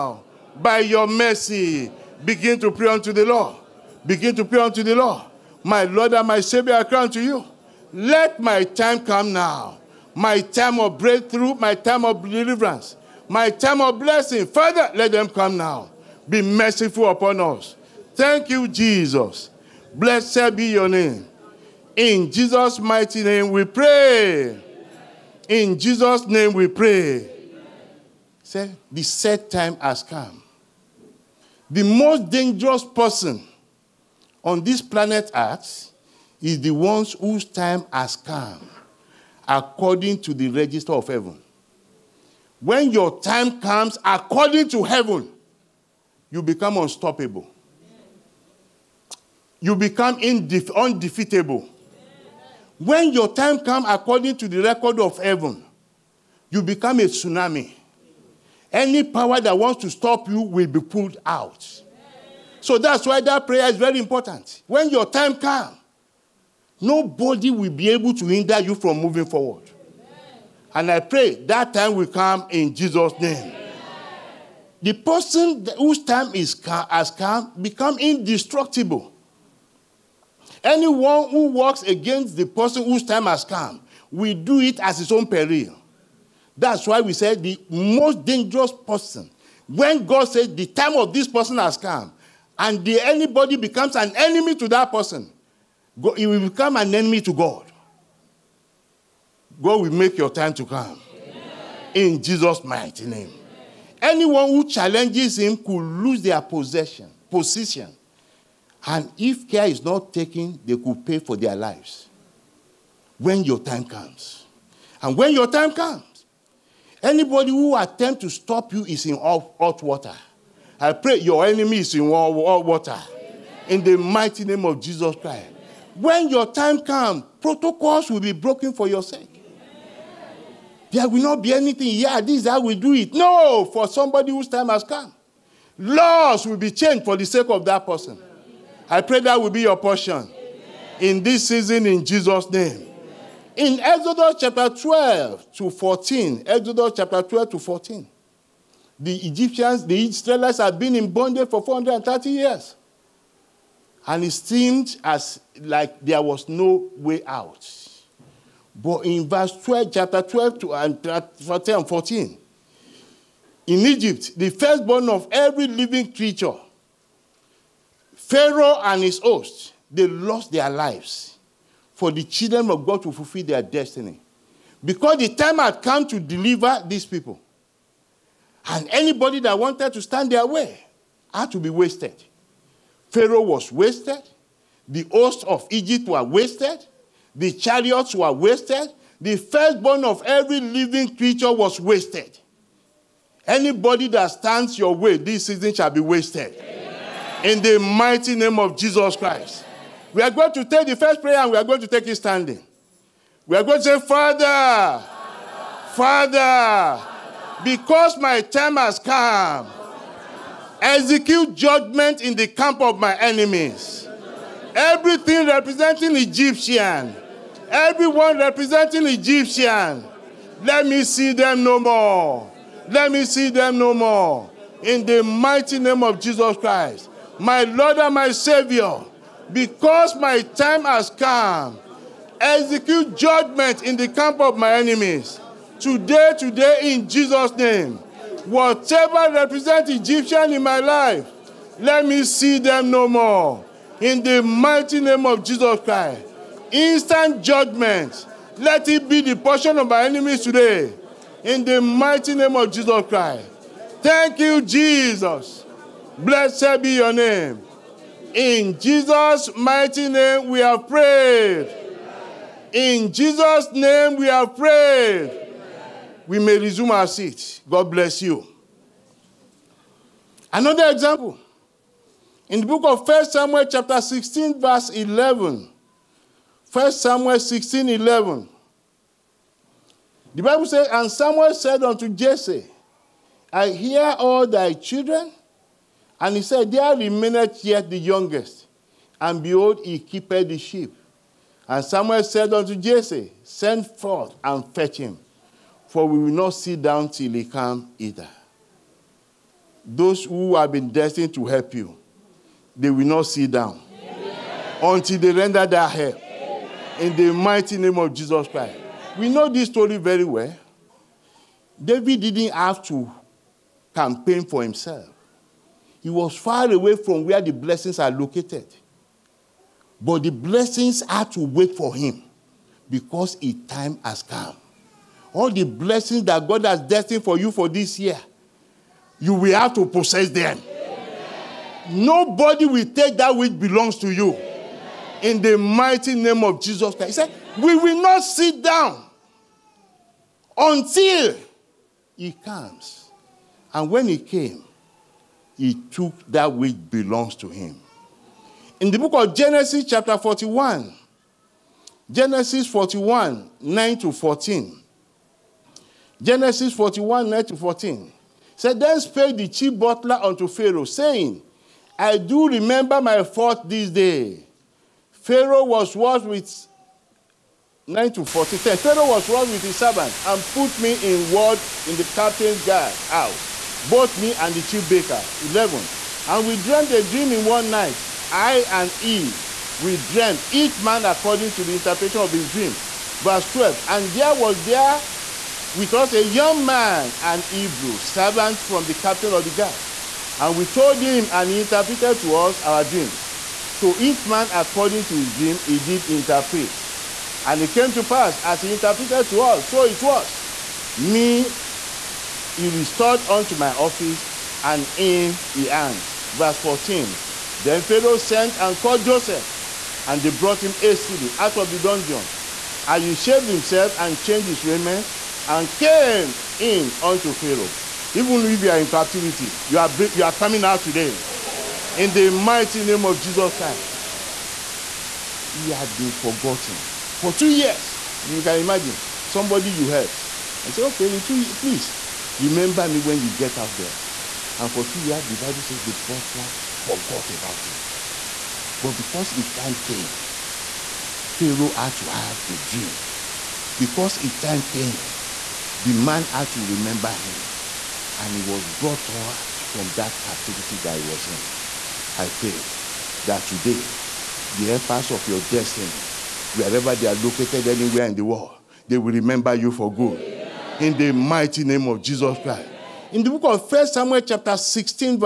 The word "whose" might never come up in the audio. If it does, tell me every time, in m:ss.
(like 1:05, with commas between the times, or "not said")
0:37, 1:15, 1:22, 2:14.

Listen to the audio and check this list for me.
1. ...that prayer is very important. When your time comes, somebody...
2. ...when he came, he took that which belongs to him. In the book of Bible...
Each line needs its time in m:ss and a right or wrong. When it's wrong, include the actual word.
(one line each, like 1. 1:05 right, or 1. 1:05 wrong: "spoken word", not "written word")
1. 1:03 wrong: "nobody", not "somebody"
2. 5:43 wrong: "Genesis", not "Bible".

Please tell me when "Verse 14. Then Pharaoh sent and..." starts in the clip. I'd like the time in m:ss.
6:46.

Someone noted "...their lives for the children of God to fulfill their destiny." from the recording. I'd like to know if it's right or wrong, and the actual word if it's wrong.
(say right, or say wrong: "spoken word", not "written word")
right.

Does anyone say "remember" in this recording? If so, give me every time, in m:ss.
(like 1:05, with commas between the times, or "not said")
6:02, 7:12, 7:26, 7:39.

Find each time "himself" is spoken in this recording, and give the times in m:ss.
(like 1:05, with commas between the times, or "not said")
5:14, 6:53.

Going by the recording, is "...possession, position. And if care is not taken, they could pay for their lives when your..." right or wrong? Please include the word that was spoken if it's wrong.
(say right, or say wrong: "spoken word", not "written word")
right.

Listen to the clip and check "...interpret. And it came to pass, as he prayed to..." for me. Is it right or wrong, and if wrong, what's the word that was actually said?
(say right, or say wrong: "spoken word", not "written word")
wrong: "interpreted", not "prayed".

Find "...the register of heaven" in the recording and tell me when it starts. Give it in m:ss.
0:40.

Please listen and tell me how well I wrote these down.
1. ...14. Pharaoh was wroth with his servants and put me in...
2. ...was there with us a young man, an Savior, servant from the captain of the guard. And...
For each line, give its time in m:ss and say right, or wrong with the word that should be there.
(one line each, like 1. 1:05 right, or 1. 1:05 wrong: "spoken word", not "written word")
1. 6:08 right
2. 6:24 wrong: "Hebrew", not "Savior".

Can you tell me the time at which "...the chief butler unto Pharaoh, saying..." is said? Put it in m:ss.
5:59.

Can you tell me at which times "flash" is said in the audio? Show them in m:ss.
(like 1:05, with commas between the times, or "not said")
not said.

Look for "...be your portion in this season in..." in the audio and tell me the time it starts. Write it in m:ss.
2:19.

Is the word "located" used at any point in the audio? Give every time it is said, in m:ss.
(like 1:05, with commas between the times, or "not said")
5:18, 7:37.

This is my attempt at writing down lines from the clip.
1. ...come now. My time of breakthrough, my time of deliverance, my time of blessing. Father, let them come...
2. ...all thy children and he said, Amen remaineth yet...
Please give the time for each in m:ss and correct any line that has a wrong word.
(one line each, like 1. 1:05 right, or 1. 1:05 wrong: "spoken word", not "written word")
1. 0:09 right
2. 4:44 wrong: "There", not "Amen".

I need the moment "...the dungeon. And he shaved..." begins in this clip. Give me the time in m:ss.
6:51.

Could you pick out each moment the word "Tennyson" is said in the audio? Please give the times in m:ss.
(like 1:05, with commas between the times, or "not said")
not said.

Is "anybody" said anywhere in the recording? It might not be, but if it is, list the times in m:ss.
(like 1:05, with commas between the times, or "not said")
1:32, 1:57, 2:58, 3:13.